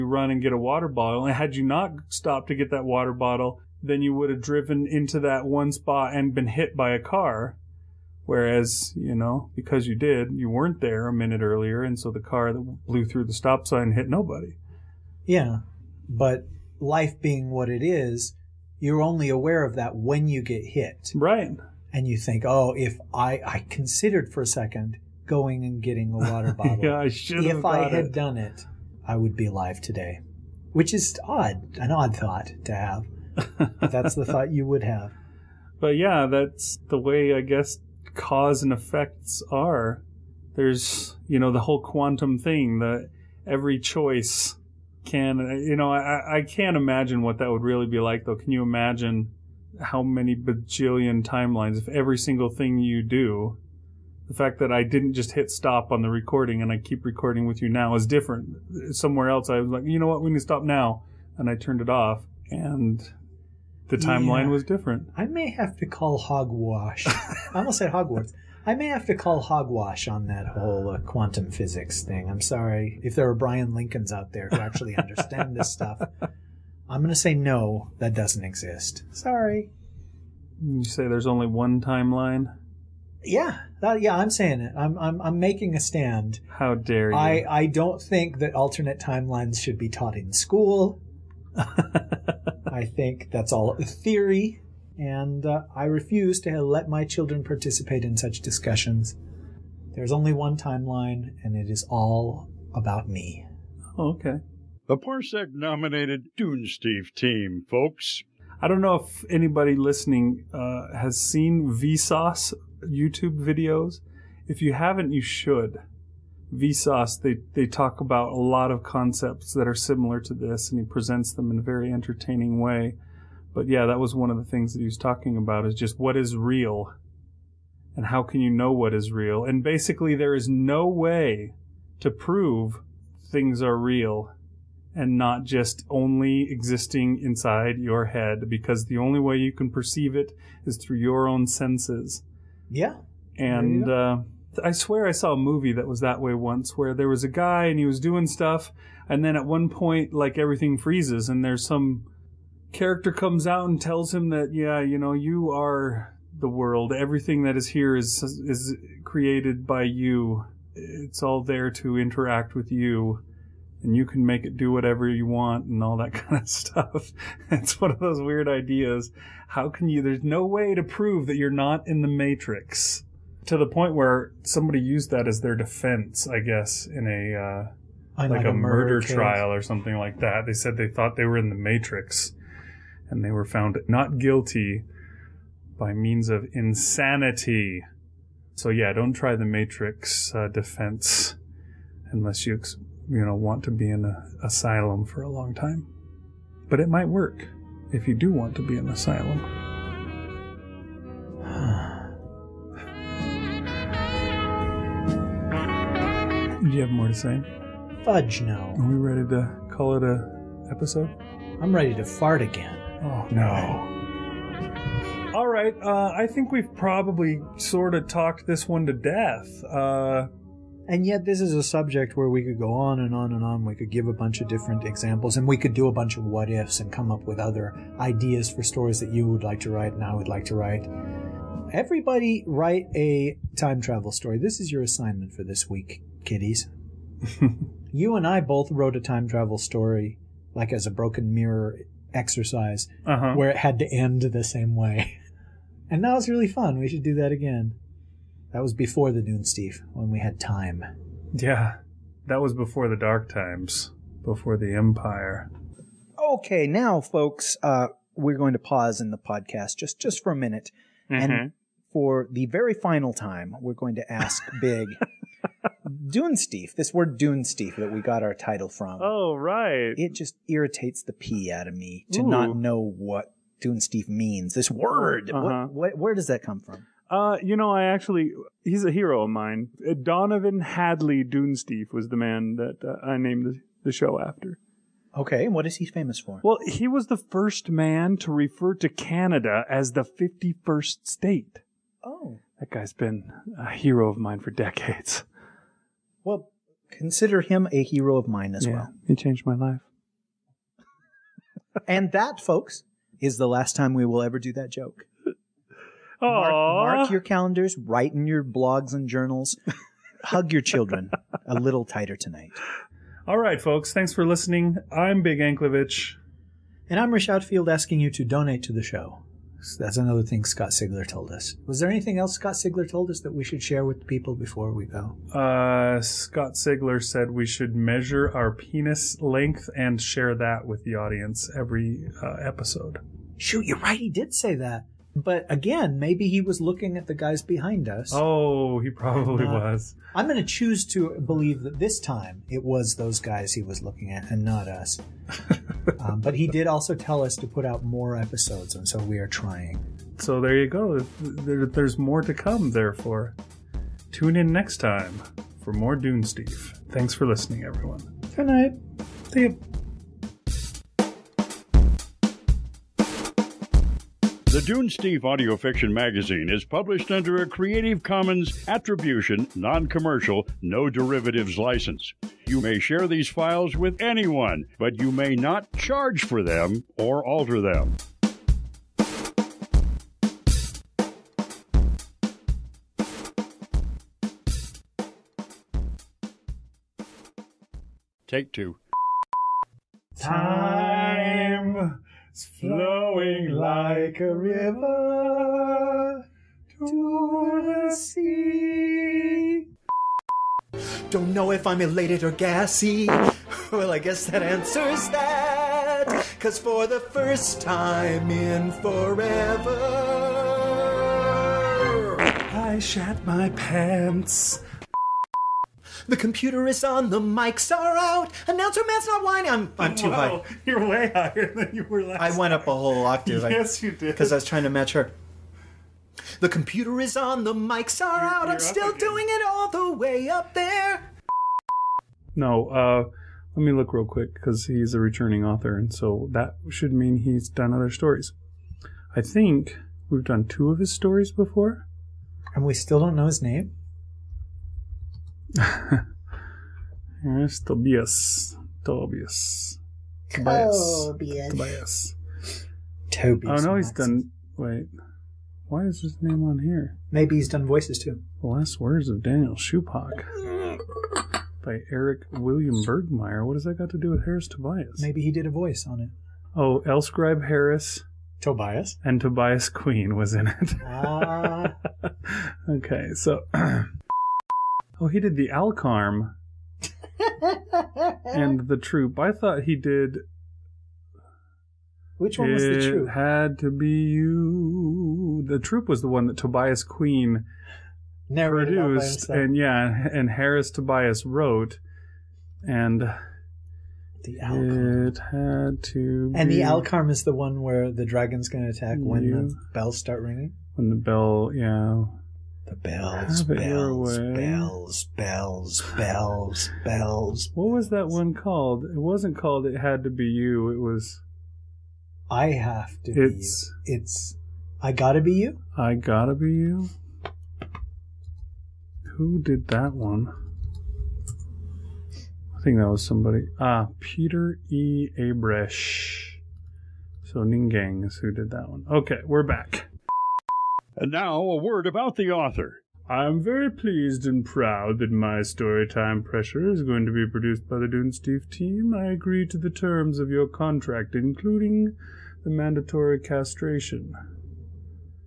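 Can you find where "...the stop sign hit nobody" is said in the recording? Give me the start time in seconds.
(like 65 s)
13 s.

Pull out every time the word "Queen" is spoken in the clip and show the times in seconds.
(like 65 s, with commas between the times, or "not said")
469 s, 486 s.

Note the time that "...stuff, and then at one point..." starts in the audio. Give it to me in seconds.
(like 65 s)
148 s.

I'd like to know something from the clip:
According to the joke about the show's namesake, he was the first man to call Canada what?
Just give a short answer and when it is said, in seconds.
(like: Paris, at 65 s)
The 51st state, at 290 s.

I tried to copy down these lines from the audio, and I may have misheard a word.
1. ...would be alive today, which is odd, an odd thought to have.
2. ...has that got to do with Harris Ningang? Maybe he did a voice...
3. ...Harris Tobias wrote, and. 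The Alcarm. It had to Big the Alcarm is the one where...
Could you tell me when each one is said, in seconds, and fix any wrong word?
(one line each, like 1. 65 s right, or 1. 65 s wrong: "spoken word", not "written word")
1. 29 s right
2. 463 s wrong: "Tobias", not "Ningang"
3. 490 s wrong: "And", not "Big".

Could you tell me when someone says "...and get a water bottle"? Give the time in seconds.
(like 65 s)
0 s.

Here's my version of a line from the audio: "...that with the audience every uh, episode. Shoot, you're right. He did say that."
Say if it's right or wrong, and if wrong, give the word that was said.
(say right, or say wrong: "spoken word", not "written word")
right.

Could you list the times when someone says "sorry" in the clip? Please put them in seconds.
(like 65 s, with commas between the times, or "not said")
72 s, 79 s.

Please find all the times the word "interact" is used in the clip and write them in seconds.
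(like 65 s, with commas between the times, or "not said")
161 s.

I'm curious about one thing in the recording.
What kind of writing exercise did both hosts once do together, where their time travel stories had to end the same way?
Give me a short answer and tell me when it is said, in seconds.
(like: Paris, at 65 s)
Broken mirror exercise, at 240 s.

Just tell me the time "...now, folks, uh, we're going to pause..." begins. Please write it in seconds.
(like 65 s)
256 s.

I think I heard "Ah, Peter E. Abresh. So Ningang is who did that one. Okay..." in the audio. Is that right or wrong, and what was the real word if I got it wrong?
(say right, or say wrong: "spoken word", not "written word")
right.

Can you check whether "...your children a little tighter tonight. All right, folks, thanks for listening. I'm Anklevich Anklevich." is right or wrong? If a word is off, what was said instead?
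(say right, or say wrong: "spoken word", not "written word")
wrong: "Big", not "Anklevich".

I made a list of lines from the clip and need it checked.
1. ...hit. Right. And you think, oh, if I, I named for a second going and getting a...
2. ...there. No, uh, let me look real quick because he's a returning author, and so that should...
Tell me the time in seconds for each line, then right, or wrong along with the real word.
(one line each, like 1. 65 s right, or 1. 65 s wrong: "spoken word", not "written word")
1. 20 s wrong: "considered", not "named"
2. 430 s right.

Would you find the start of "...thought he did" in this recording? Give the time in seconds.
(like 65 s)
479 s.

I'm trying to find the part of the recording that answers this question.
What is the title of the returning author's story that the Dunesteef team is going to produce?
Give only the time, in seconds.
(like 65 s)
535 s.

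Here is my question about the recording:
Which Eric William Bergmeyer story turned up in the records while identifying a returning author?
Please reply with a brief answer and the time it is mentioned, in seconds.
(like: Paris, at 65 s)
The Last Words of Daniel Shupak, at 458 s.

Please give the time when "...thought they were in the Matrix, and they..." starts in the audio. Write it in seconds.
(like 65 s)
180 s.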